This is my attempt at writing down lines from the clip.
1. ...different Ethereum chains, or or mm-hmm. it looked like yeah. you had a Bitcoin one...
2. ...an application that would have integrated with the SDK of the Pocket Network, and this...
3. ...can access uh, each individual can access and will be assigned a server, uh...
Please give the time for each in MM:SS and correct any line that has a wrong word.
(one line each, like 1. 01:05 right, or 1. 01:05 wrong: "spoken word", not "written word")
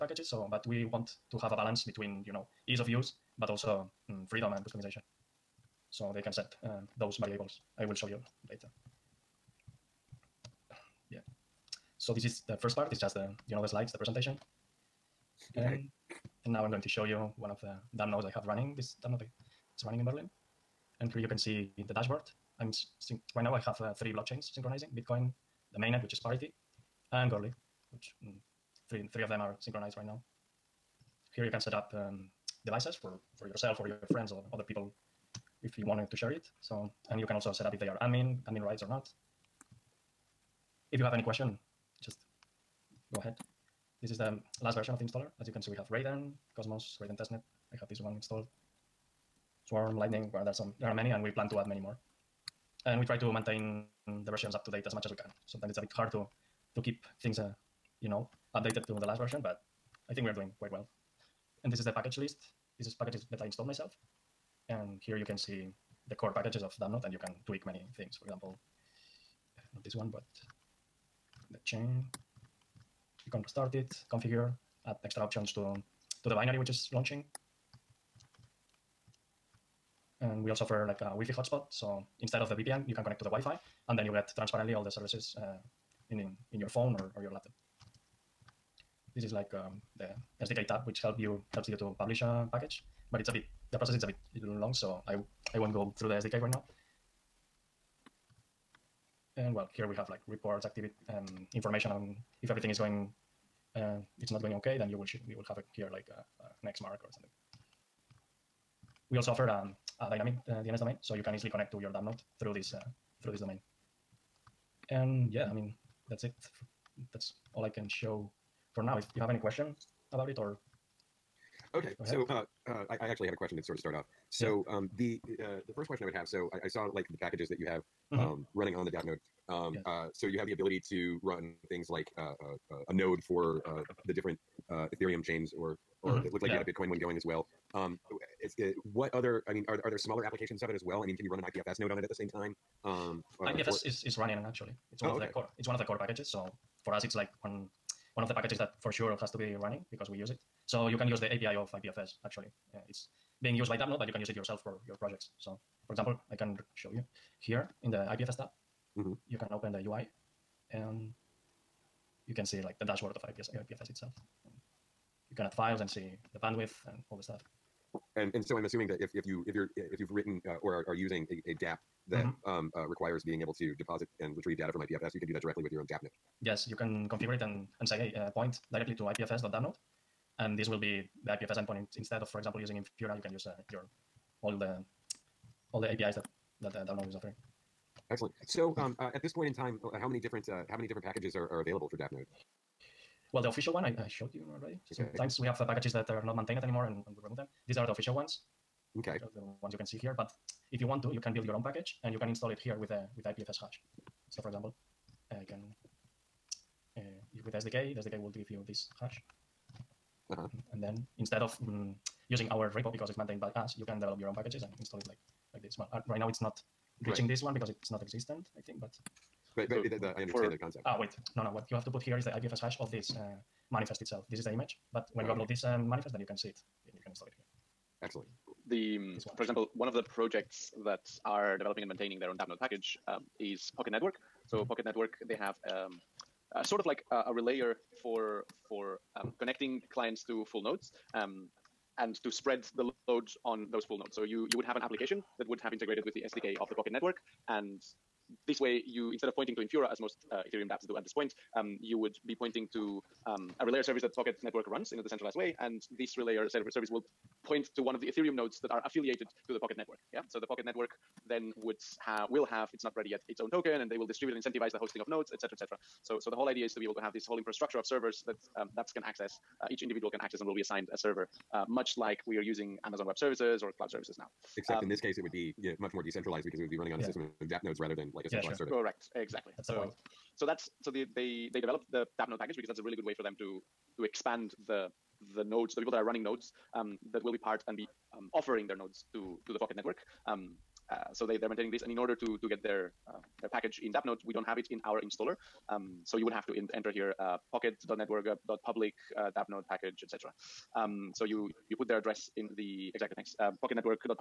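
1. 02:14 right
2. 04:04 right
3. 04:28 right.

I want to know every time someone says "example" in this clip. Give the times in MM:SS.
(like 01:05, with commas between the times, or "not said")
01:08, 02:35, 03:02, 03:24, 03:49.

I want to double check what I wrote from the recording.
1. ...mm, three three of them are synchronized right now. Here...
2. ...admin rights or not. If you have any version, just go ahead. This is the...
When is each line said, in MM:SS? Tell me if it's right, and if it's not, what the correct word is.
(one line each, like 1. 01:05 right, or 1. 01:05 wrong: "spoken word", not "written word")
1. 00:28 right
2. 00:38 wrong: "question", not "version".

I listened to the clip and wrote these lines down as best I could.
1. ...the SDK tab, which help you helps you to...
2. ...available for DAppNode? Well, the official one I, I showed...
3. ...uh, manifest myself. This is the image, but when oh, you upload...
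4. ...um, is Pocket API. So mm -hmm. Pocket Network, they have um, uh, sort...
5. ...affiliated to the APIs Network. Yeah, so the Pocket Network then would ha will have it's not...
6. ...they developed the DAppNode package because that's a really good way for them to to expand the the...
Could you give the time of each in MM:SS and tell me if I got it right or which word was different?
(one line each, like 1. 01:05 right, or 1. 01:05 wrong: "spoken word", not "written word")
1. 01:29 right
2. 03:11 right
3. 03:43 wrong: "itself", not "myself"
4. 03:53 wrong: "Network", not "API"
5. 04:18 wrong: "Pocket", not "APIs"
6. 04:41 right.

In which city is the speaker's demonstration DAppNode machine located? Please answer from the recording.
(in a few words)
Berlin.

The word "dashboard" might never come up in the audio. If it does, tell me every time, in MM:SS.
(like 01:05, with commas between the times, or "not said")
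00:21, 02:42.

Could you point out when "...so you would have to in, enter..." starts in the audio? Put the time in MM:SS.
04:56.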